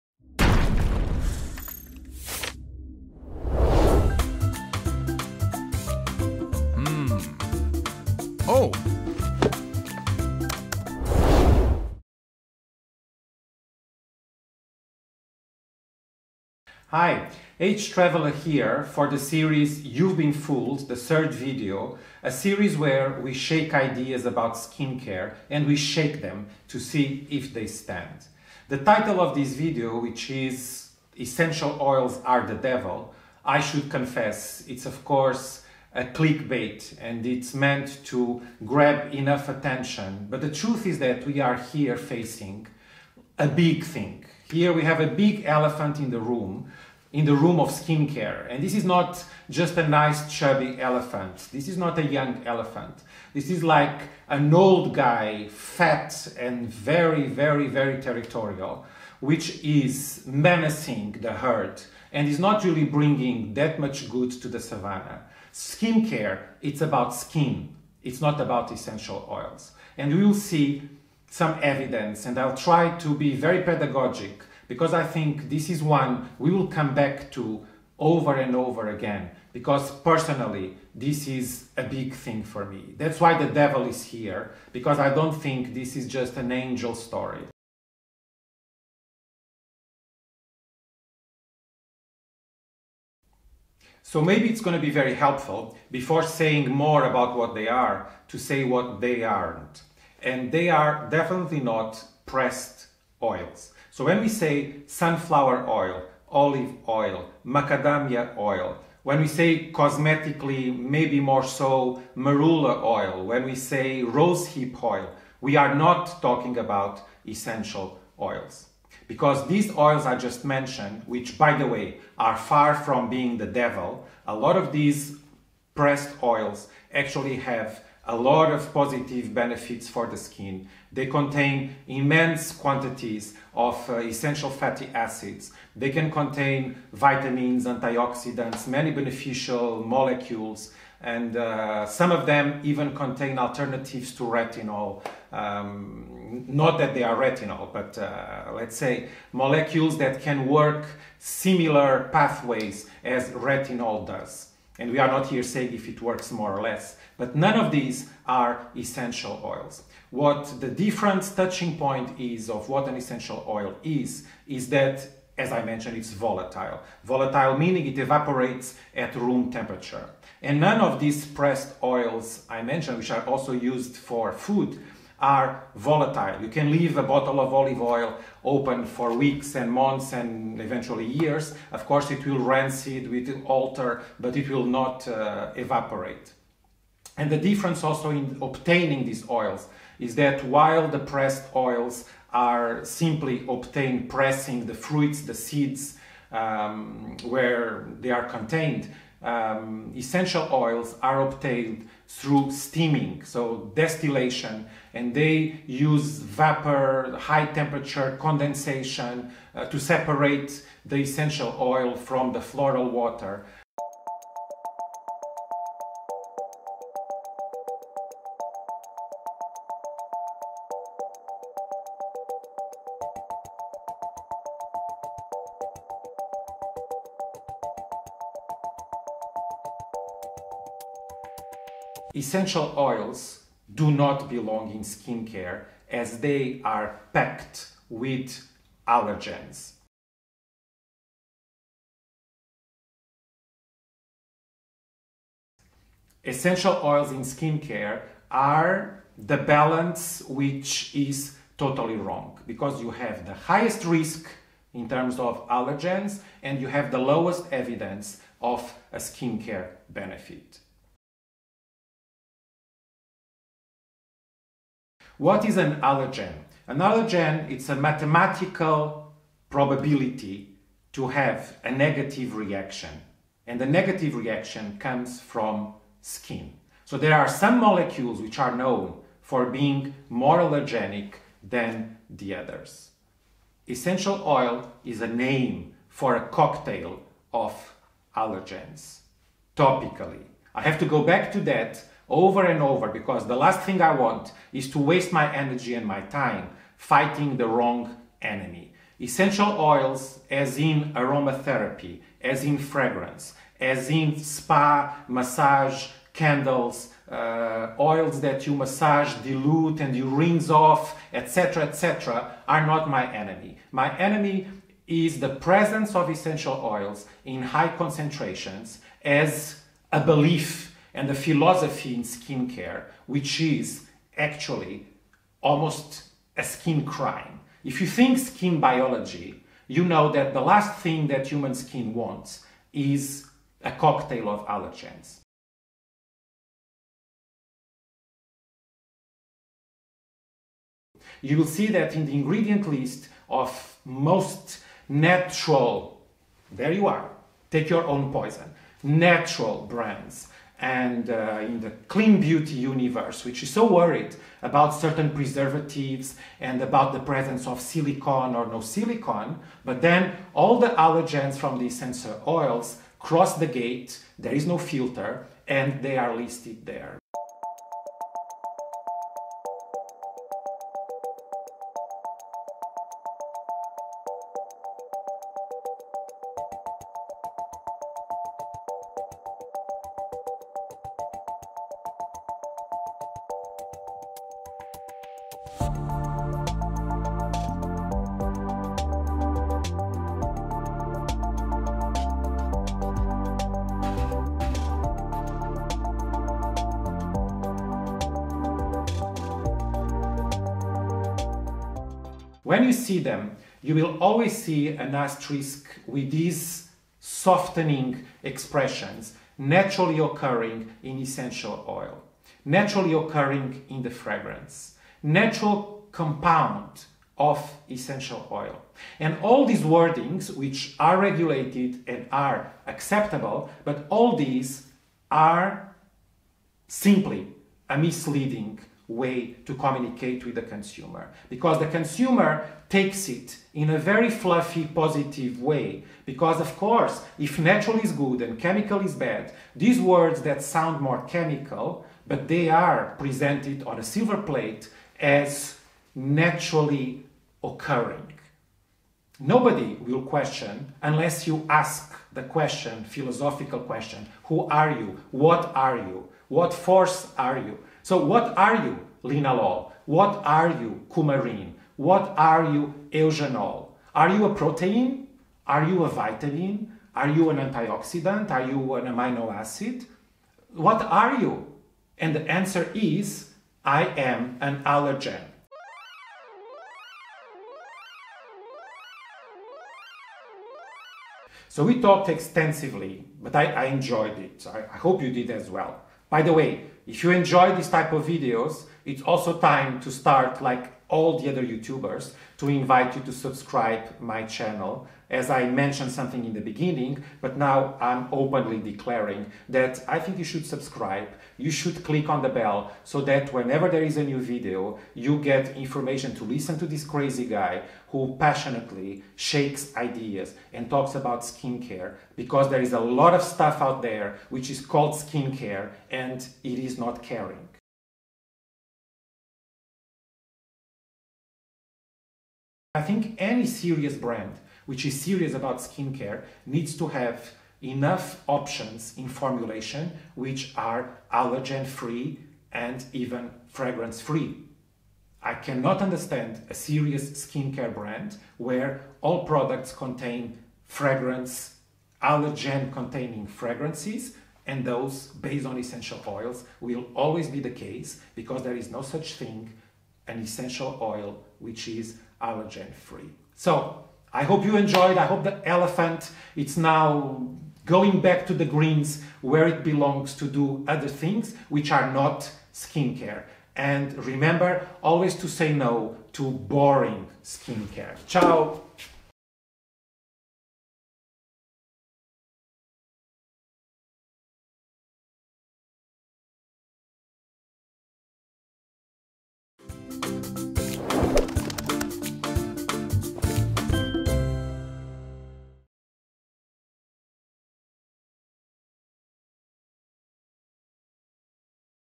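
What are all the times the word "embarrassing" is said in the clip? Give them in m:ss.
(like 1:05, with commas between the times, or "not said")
not said.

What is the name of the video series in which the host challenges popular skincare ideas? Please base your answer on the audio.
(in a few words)
You've Been Fooled.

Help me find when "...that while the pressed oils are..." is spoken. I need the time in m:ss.
3:10.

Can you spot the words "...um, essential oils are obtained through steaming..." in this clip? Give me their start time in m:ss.
3:19.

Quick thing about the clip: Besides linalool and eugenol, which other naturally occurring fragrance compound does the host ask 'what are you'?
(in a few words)
coumarin.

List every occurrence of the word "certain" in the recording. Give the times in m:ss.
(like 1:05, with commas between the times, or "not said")
5:54.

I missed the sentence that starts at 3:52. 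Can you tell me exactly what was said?
Essential oils do not belong in skincare as they are packed with allergens.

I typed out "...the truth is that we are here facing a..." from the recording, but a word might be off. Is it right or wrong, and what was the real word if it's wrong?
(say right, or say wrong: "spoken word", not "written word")
right.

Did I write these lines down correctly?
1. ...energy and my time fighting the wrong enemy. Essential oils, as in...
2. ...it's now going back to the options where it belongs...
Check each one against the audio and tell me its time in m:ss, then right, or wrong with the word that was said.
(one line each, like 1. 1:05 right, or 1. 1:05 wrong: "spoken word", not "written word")
1. 4:55 right
2. 9:16 wrong: "greens", not "options".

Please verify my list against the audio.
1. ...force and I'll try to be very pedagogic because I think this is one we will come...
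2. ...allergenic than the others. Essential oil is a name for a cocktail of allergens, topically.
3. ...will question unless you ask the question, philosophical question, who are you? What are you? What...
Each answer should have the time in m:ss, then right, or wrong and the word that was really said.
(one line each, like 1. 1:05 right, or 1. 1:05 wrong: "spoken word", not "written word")
1. 1:11 wrong: "evidence", not "force"
2. 4:40 right
3. 7:29 right.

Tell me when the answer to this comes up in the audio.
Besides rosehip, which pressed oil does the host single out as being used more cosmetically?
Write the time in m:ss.
1:52.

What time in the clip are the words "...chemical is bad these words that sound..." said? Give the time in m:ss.
7:18.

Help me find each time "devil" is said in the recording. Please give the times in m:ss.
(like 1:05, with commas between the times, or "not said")
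0:32, 1:23, 2:03.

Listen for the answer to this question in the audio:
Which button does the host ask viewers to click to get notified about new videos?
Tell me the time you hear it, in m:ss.
8:22.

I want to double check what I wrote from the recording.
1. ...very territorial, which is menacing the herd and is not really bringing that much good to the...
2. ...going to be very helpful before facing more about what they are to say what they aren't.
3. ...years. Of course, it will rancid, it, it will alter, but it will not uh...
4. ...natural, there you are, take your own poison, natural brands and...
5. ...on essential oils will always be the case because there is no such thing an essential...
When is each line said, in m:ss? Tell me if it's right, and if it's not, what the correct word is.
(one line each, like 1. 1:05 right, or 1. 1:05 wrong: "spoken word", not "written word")
1. 0:57 right
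2. 1:34 wrong: "saying", not "facing"
3. 3:01 right
4. 5:44 right
5. 9:05 right.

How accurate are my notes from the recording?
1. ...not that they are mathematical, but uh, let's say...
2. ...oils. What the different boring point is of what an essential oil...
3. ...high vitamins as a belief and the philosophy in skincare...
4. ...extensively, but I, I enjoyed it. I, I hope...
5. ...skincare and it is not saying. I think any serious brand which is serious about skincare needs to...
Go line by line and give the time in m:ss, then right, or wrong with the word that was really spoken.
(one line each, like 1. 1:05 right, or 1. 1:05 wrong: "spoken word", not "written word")
1. 2:26 wrong: "retinal", not "mathematical"
2. 2:39 wrong: "touching", not "boring"
3. 5:17 wrong: "concentrations", not "vitamins"
4. 8:02 right
5. 8:34 wrong: "caring", not "saying".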